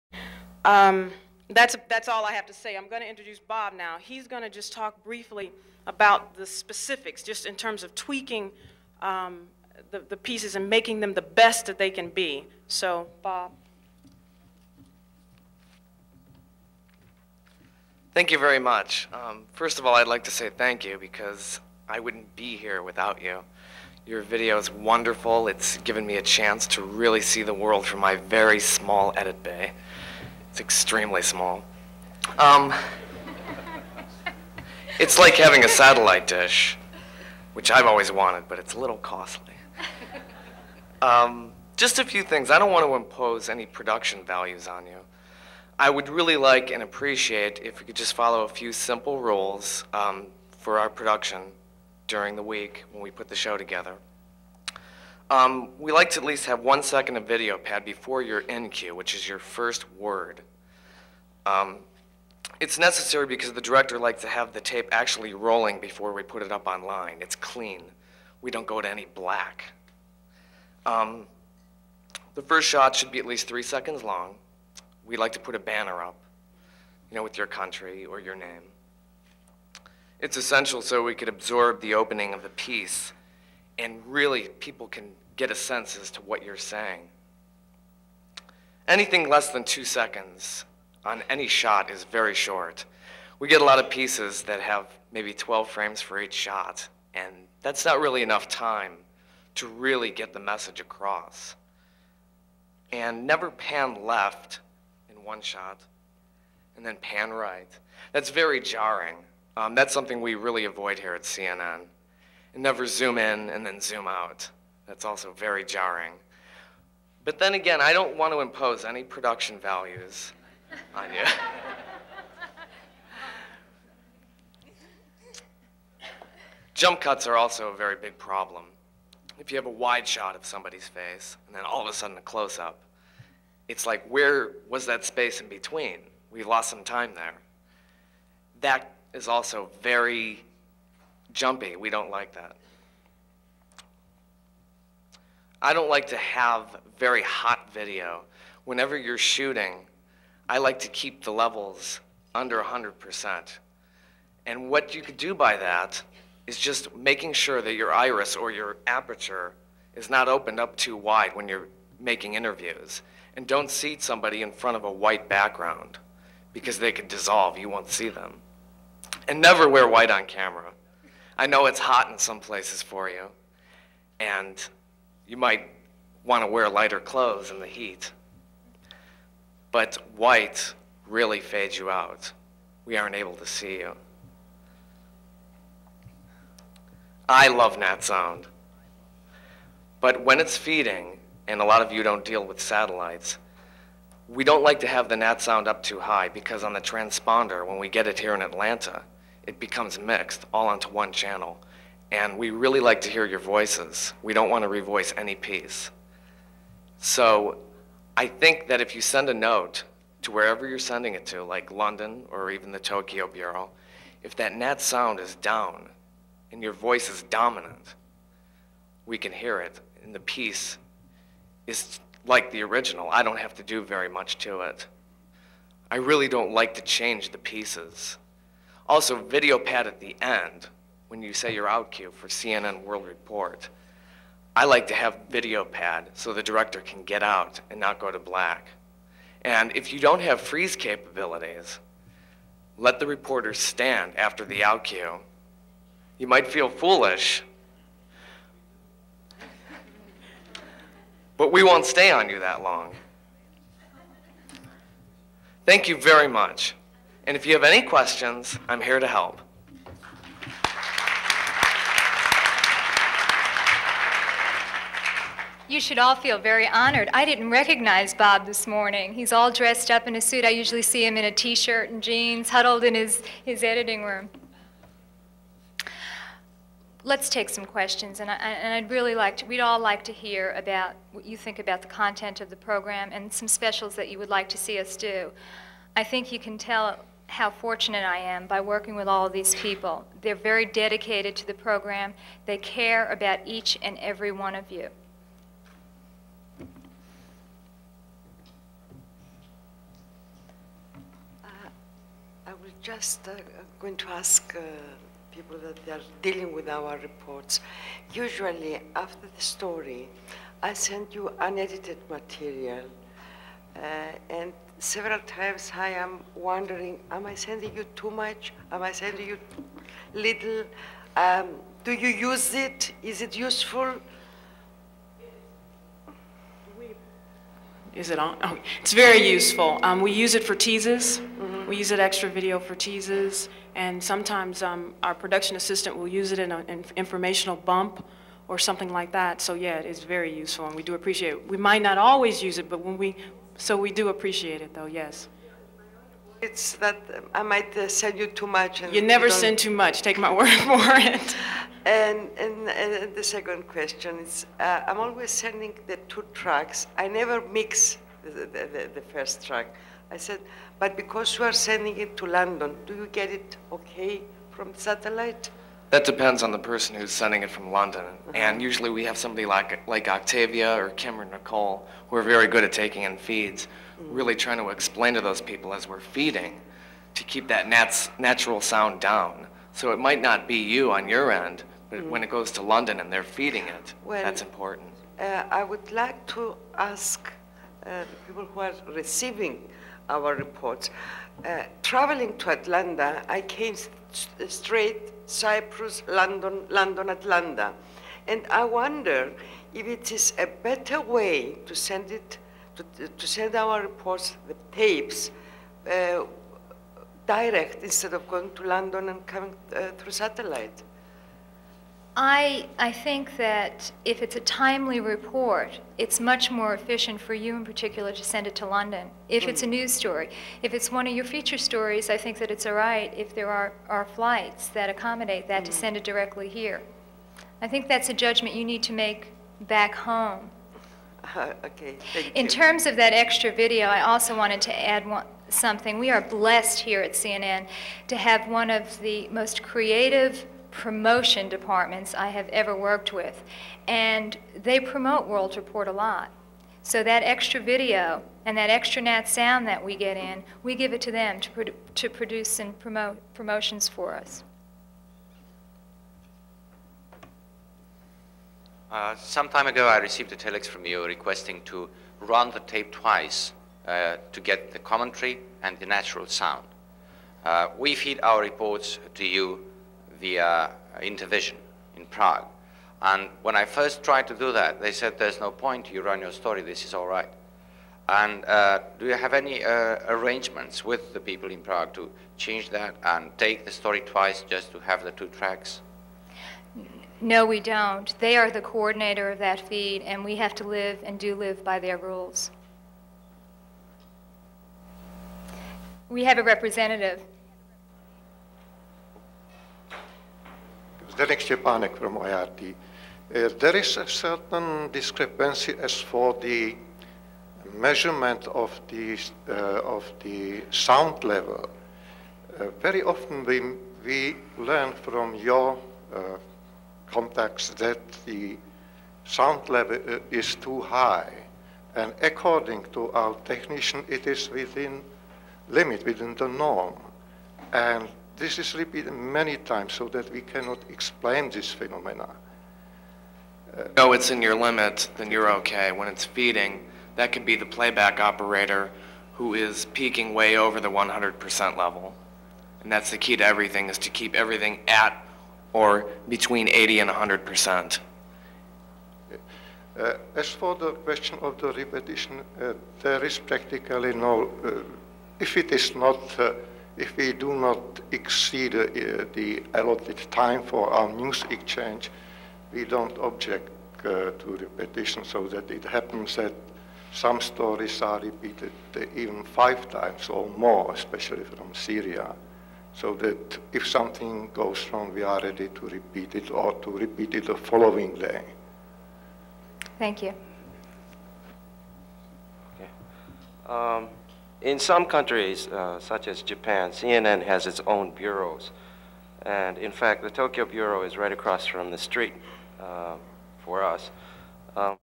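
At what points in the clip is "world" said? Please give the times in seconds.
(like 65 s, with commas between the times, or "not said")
27 s, 232 s, 445 s.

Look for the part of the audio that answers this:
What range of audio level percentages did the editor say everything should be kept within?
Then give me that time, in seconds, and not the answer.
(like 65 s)
546 s.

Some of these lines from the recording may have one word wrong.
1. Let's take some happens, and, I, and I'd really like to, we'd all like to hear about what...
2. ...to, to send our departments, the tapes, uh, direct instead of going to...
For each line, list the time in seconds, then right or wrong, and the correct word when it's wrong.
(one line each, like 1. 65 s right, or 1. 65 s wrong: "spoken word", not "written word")
1. 277 s wrong: "questions", not "happens"
2. 402 s wrong: "reports", not "departments".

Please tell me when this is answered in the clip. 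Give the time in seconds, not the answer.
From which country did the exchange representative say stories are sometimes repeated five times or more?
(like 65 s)
571 s.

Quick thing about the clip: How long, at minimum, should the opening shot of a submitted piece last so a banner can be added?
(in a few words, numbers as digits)
3 seconds.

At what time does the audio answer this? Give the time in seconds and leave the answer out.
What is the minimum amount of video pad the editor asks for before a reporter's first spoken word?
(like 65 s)
56 s.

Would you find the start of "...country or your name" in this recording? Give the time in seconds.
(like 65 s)
77 s.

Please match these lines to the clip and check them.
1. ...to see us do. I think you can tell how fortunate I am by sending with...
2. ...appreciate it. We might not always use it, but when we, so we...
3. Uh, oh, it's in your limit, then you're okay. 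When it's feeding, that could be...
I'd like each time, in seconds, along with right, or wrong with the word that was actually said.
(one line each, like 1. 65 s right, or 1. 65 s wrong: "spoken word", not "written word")
1. 284 s wrong: "working", not "sending"
2. 340 s right
3. 533 s right.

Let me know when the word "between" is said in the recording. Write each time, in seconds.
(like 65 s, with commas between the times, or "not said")
135 s, 546 s.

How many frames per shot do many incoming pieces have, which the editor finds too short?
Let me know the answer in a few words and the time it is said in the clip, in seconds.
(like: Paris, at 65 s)
12, at 95 s.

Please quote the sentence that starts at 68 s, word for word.
We don't go to any black.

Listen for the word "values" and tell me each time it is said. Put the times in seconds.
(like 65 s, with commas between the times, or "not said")
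44 s, 119 s.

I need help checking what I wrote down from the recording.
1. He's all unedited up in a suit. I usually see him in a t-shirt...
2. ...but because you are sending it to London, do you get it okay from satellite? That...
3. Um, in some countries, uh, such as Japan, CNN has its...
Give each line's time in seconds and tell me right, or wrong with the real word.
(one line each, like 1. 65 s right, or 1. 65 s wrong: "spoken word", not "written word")
1. 269 s wrong: "dressed", not "unedited"
2. 360 s right
3. 583 s right.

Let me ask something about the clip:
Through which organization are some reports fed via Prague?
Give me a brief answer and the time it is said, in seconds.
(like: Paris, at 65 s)
Intervision, at 471 s.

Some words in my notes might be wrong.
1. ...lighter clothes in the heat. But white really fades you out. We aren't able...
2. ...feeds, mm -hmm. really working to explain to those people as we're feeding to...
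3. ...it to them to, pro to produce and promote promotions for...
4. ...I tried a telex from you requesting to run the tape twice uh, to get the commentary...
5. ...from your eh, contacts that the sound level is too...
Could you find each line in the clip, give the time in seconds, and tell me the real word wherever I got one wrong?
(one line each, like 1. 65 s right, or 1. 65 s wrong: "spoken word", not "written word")
1. 176 s right
2. 373 s wrong: "trying", not "working"
3. 450 s right
4. 459 s wrong: "received", not "tried"
5. 514 s right.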